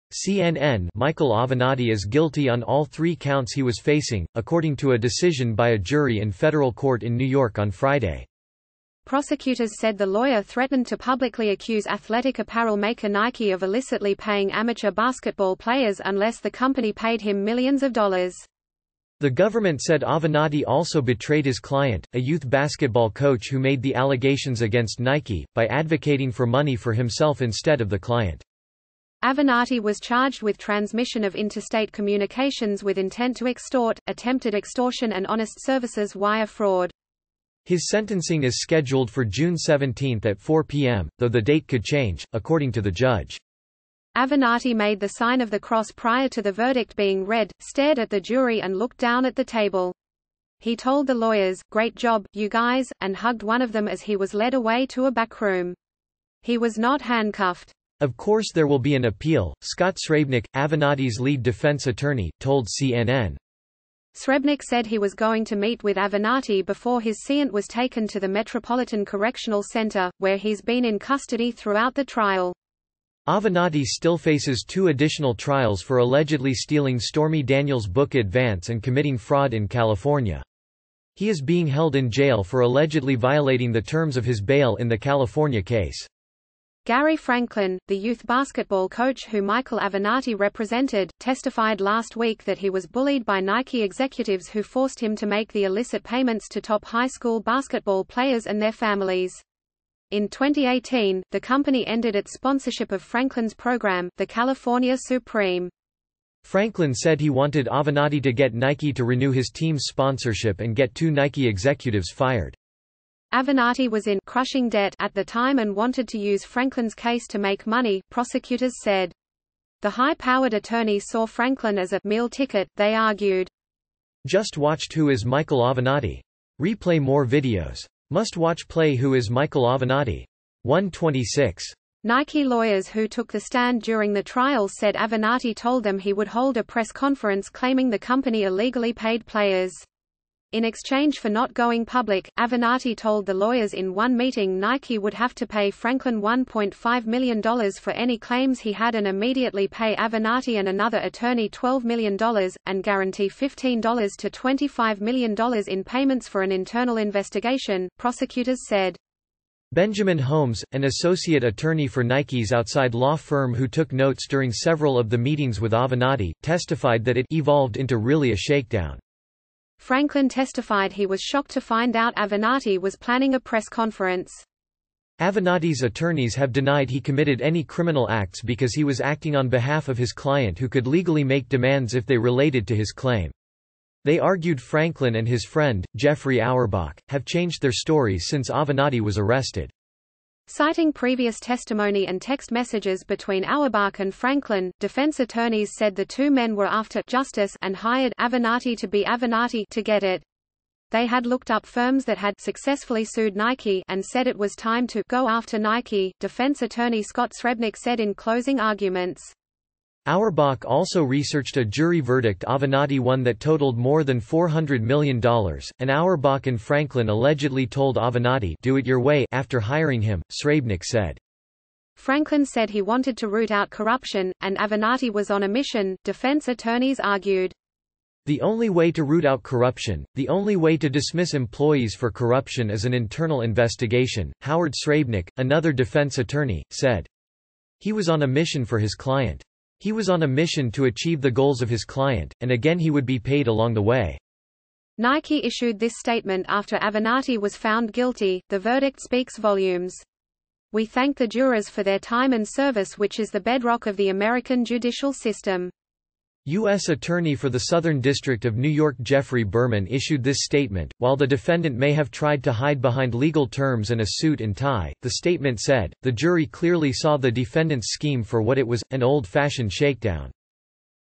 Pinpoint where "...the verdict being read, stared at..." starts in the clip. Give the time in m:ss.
0:46.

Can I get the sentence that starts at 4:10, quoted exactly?
We thank the jurors for their time and service which is the bedrock of the American judicial system.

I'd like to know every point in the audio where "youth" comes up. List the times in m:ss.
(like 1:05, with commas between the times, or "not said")
0:22, 1:27.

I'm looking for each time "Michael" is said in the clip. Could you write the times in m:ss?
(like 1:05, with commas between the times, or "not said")
0:00, 1:29, 2:05, 2:09.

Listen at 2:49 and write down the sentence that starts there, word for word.
Franklin testified he was shocked to find out Avenatti was planning a press conference.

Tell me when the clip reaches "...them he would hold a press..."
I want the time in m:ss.
2:15.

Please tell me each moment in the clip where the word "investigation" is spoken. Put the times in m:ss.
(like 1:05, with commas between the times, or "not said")
2:36, 3:53.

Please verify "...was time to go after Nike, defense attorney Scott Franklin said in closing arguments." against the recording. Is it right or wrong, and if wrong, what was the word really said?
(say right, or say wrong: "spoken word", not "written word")
wrong: "Srebnick", not "Franklin".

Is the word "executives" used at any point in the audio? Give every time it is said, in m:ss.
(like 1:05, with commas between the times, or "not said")
1:33, 1:51.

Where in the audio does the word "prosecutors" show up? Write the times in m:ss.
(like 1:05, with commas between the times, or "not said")
0:09, 1:58, 2:37.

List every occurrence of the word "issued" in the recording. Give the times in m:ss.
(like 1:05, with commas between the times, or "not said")
4:05, 4:19.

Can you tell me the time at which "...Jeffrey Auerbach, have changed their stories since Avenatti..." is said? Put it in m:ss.
3:05.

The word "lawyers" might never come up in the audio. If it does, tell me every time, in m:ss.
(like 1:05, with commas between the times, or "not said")
0:10, 0:51, 2:12, 2:23.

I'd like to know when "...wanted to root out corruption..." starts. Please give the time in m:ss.
3:42.